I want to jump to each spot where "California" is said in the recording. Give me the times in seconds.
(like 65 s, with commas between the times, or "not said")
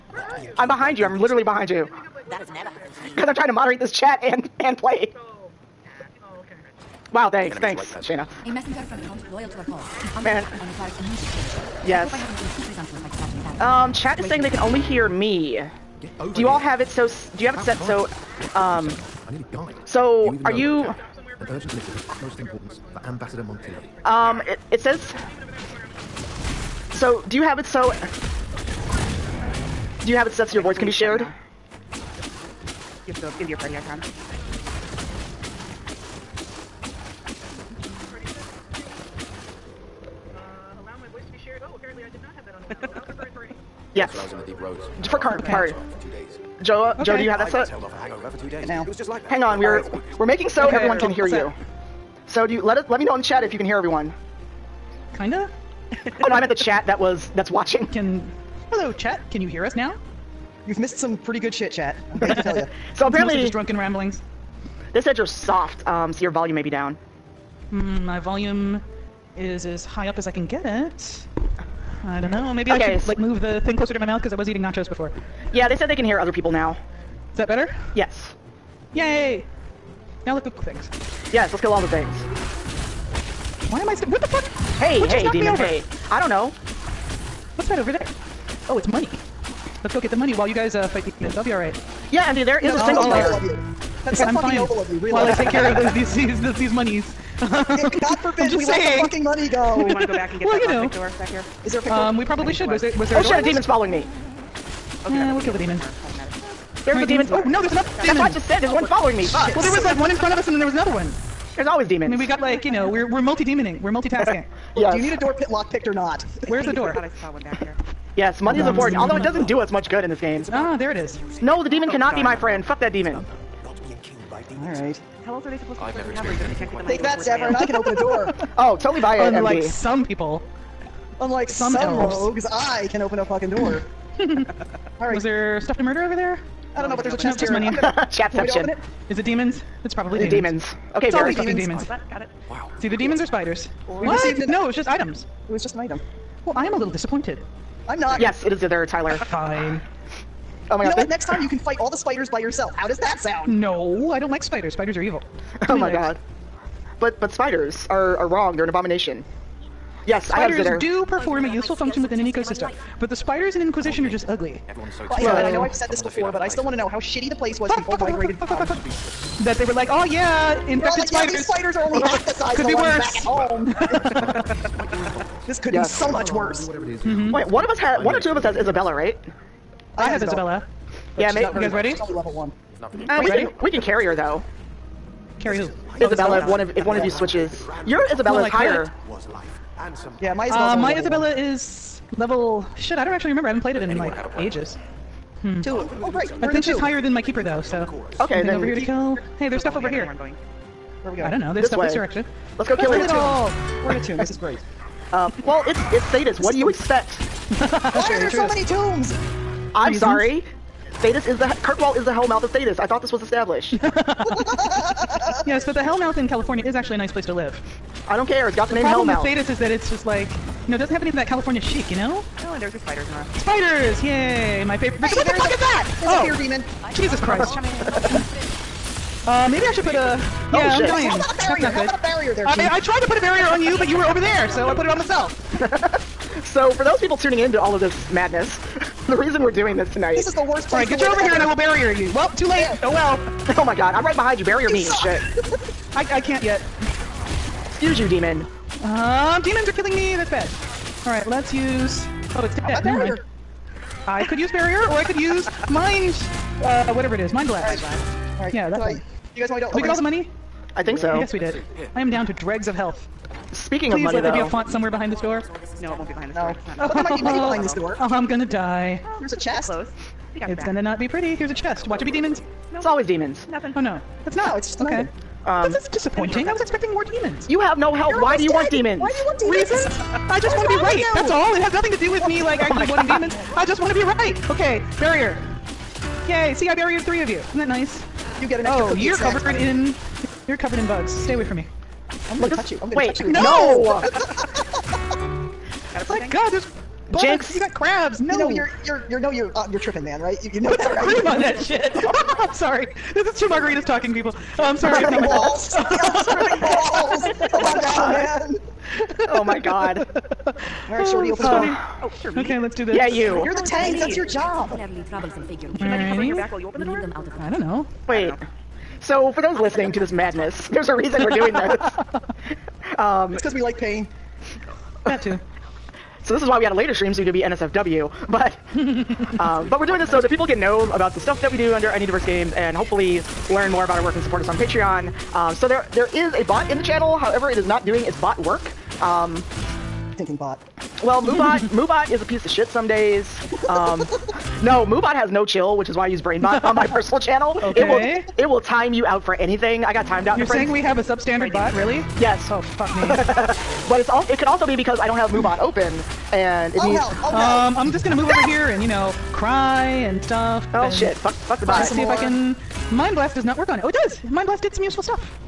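216 s, 221 s.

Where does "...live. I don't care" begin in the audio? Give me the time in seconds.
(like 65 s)
217 s.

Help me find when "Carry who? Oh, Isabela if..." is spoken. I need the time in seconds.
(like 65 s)
185 s.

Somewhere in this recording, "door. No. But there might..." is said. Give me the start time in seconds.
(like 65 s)
266 s.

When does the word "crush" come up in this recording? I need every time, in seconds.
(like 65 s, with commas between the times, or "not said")
not said.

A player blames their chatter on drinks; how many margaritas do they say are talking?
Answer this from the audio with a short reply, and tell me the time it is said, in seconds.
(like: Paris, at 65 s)
2, at 303 s.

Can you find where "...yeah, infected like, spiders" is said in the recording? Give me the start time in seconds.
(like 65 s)
170 s.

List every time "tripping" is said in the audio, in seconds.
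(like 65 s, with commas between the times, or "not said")
299 s.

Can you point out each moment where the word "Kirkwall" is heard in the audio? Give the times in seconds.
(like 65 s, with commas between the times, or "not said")
211 s.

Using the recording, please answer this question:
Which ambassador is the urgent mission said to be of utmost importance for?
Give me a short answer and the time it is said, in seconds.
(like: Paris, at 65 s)
Montilyet, at 23 s.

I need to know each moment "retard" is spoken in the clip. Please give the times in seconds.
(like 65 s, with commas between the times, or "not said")
not said.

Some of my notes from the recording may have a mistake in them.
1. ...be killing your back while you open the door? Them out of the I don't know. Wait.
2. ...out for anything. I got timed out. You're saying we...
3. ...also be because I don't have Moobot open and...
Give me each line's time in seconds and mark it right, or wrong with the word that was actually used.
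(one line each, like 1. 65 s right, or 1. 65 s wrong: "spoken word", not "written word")
1. 315 s wrong: "covering", not "killing"
2. 349 s right
3. 354 s right.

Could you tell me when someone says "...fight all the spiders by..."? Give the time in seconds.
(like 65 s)
151 s.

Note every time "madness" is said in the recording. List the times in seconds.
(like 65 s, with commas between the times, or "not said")
238 s, 320 s.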